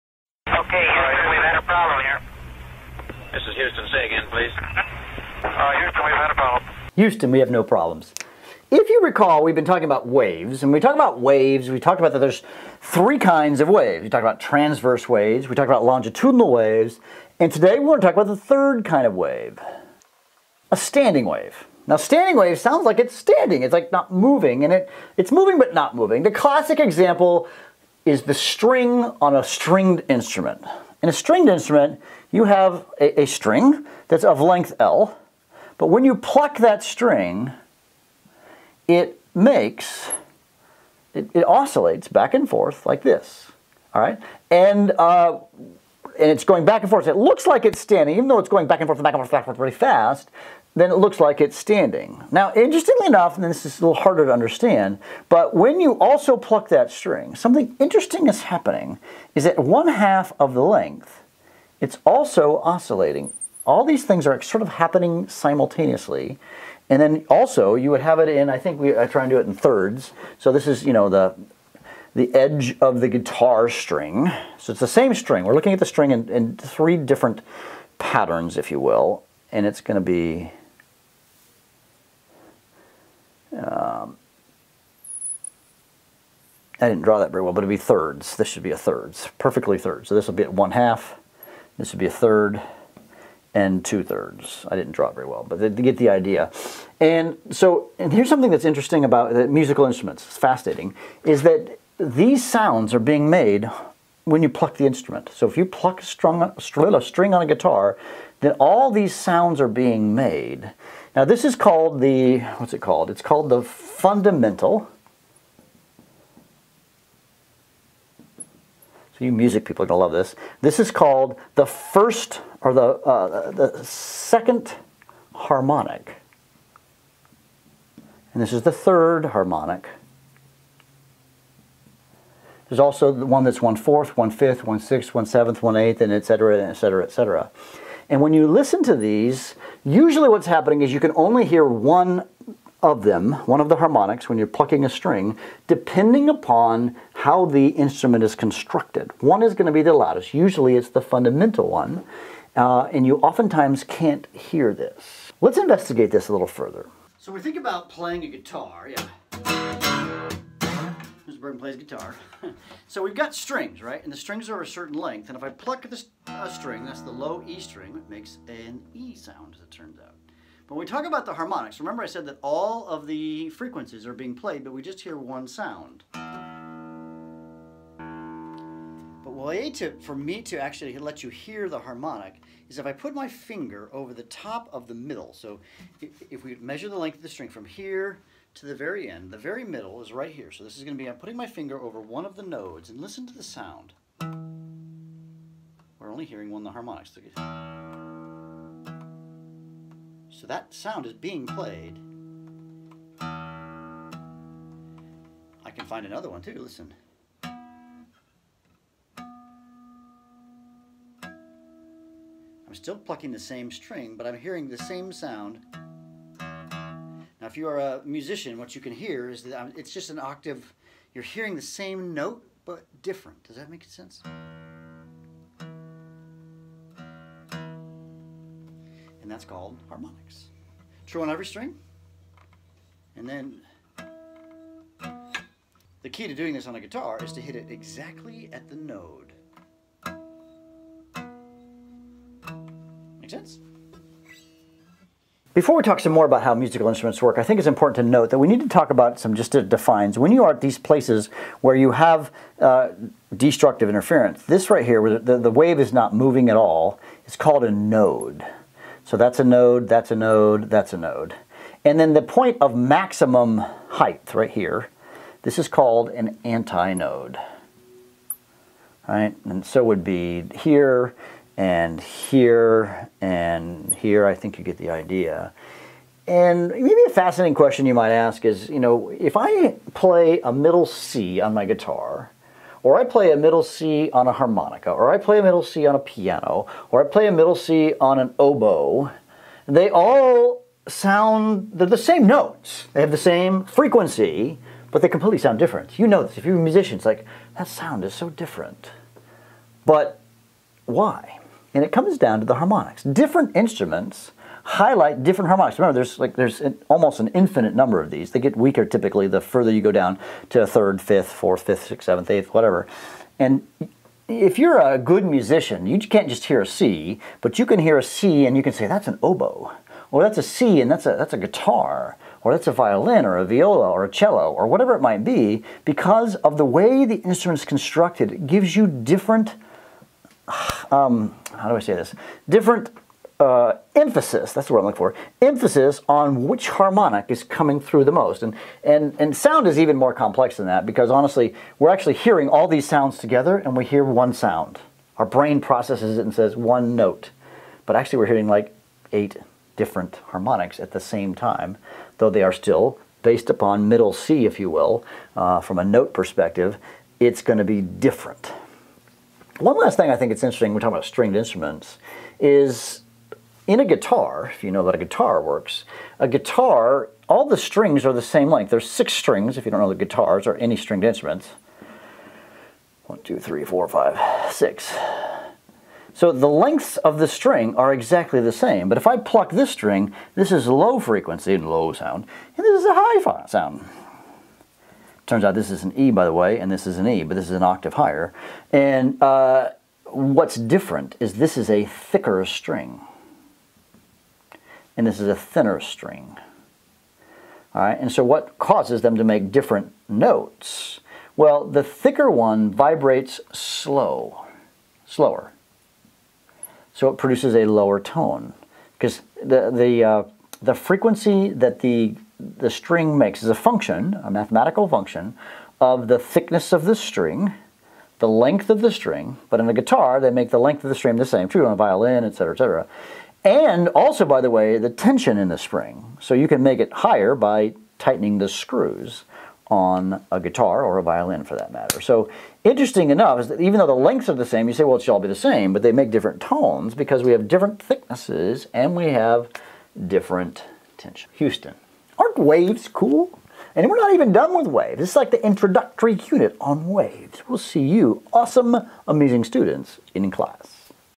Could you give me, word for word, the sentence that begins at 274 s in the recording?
I think you get the idea.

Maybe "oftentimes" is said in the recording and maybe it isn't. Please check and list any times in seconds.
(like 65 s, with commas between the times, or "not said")
153 s.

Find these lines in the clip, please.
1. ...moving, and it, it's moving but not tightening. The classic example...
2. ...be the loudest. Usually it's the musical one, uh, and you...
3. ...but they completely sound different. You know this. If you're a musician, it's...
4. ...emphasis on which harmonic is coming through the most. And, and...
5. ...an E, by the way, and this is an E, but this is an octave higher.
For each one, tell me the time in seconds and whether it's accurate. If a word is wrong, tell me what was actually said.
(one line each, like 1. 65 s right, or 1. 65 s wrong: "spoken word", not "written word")
1. 24 s wrong: "moving", not "tightening"
2. 149 s wrong: "fundamental", not "musical"
3. 294 s right
4. 335 s right
5. 385 s right.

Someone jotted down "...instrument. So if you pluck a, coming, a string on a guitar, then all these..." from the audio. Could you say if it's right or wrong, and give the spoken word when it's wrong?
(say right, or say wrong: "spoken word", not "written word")
wrong: "strung", not "coming".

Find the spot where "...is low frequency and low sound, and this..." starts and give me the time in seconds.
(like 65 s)
380 s.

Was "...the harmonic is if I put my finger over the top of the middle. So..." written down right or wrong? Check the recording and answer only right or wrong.
right.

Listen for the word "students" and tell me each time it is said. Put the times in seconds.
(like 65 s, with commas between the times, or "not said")
449 s.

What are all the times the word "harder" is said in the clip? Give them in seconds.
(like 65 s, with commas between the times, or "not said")
54 s.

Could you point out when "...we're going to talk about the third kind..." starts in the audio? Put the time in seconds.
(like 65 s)
17 s.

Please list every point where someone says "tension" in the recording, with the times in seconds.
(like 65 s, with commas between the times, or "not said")
424 s, 440 s.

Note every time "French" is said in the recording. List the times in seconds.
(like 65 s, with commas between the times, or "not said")
not said.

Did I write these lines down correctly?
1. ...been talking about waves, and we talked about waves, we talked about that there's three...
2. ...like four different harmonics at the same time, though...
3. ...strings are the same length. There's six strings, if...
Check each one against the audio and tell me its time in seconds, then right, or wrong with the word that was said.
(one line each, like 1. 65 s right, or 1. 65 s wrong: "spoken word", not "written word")
1. 9 s right
2. 348 s wrong: "eight", not "four"
3. 367 s right.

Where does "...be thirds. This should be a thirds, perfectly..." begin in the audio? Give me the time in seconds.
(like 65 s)
87 s.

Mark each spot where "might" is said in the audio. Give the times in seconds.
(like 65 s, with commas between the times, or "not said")
277 s, 325 s.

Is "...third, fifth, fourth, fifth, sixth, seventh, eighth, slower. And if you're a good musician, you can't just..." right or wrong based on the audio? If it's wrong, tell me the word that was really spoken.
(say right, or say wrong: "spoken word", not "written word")
wrong: "whatever", not "slower".